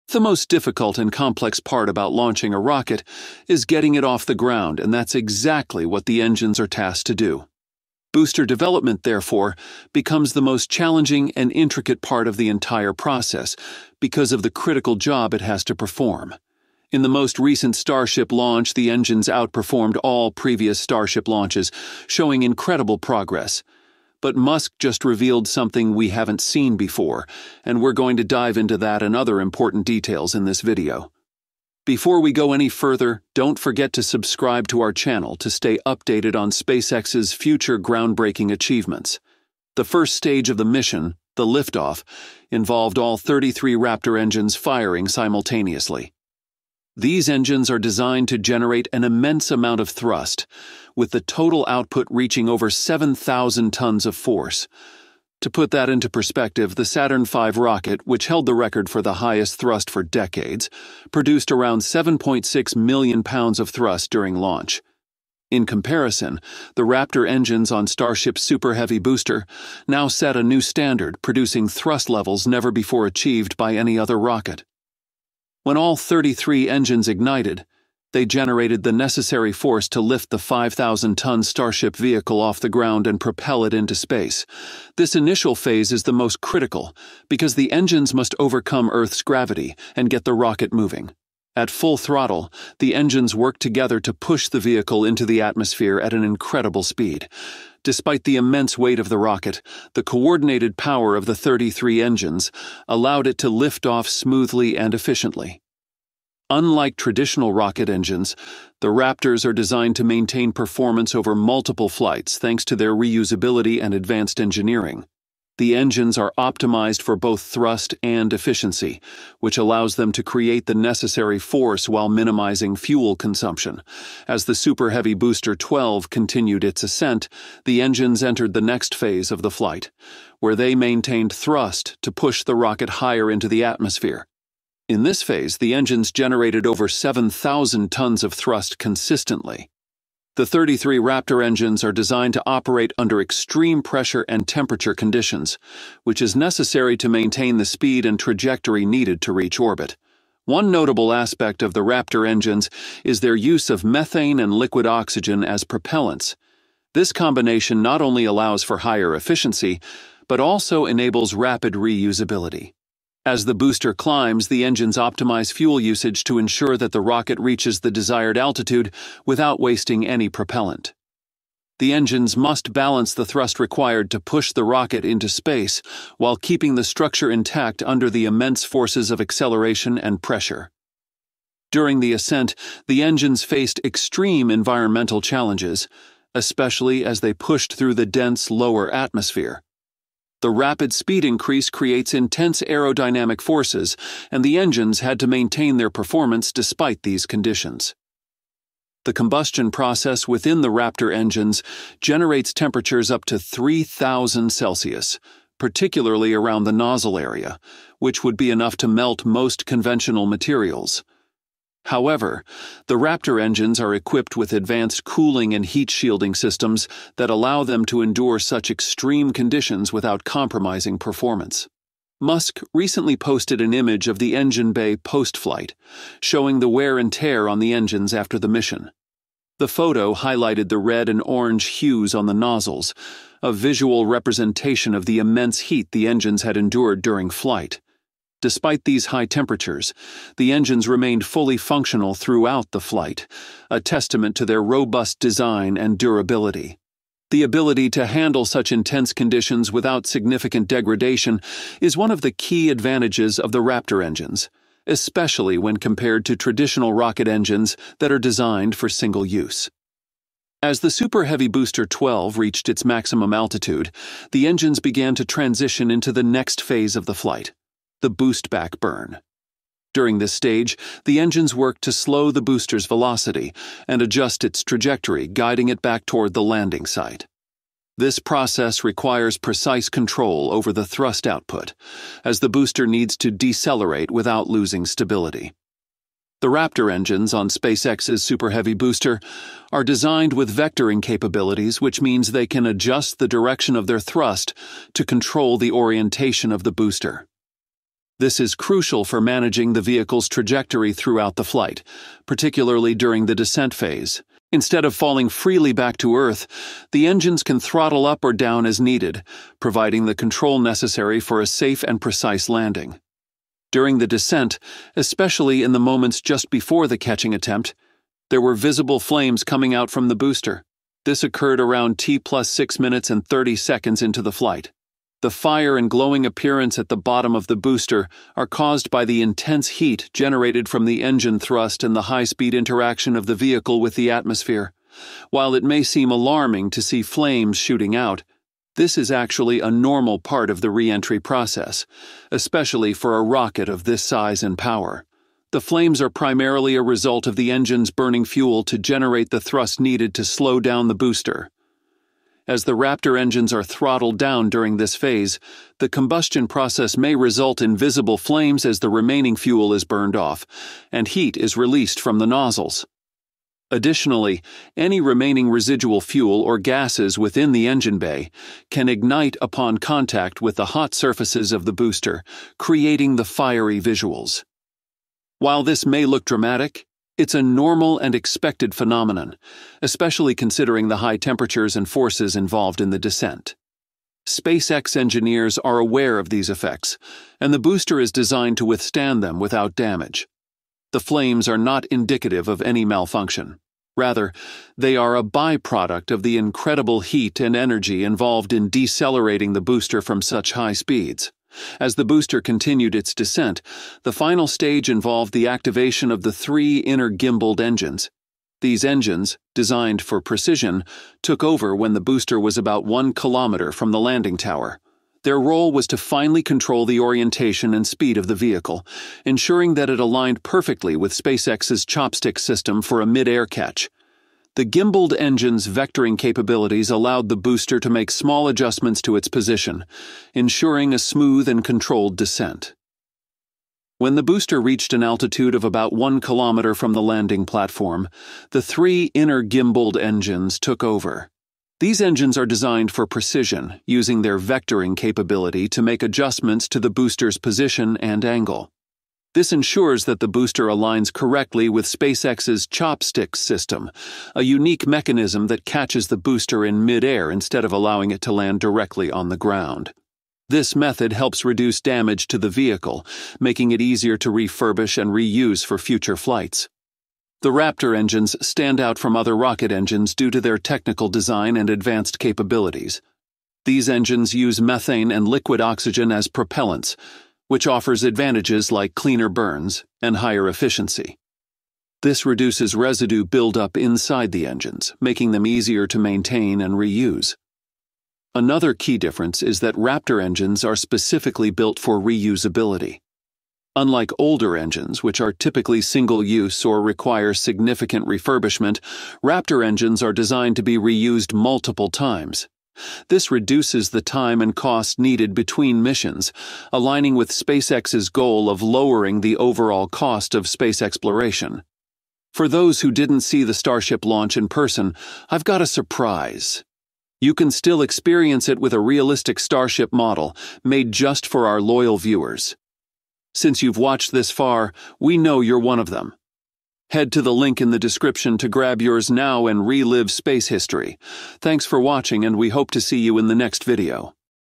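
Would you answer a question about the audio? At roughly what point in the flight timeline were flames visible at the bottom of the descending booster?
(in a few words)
T plus 6 minutes 30 seconds.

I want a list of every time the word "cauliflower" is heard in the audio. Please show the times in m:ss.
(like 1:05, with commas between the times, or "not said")
not said.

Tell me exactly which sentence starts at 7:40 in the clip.
This method helps reduce damage to the vehicle, making it easier to refurbish and reuse for future flights.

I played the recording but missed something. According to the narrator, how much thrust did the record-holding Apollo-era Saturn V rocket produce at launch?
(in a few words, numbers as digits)
7.6 million pounds.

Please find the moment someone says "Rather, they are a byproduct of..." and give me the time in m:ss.
6:33.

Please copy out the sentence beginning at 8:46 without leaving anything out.
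Head to the link in the description to grab yours now and relive space history.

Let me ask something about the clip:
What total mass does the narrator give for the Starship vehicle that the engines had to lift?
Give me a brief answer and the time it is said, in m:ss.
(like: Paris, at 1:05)
5,000 tons, at 1:20.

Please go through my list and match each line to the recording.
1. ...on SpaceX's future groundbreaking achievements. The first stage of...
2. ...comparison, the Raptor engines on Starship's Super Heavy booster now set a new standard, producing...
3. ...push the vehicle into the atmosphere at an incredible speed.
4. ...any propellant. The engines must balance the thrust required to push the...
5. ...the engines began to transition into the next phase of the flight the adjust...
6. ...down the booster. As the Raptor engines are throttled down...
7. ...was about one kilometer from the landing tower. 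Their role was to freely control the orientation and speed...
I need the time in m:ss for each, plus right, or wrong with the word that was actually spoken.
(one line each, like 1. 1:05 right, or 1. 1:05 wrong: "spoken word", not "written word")
1. 0:36 right
2. 1:05 right
3. 1:34 right
4. 2:50 right
5. 4:24 wrong: "boost", not "adjust"
6. 5:50 right
7. 6:52 wrong: "finally", not "freely".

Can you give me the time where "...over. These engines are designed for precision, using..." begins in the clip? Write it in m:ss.
7:20.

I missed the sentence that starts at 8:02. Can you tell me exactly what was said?
This reduces residue buildup inside the engines, making them easier to maintain and reuse.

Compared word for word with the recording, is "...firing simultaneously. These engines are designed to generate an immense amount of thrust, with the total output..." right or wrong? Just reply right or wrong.
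right.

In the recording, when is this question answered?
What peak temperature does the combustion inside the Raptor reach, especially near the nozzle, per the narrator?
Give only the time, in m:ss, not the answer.
3:23.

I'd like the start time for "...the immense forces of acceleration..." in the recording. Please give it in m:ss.
2:58.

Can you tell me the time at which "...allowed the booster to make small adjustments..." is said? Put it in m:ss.
7:06.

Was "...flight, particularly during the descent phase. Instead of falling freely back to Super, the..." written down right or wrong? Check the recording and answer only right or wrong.
wrong.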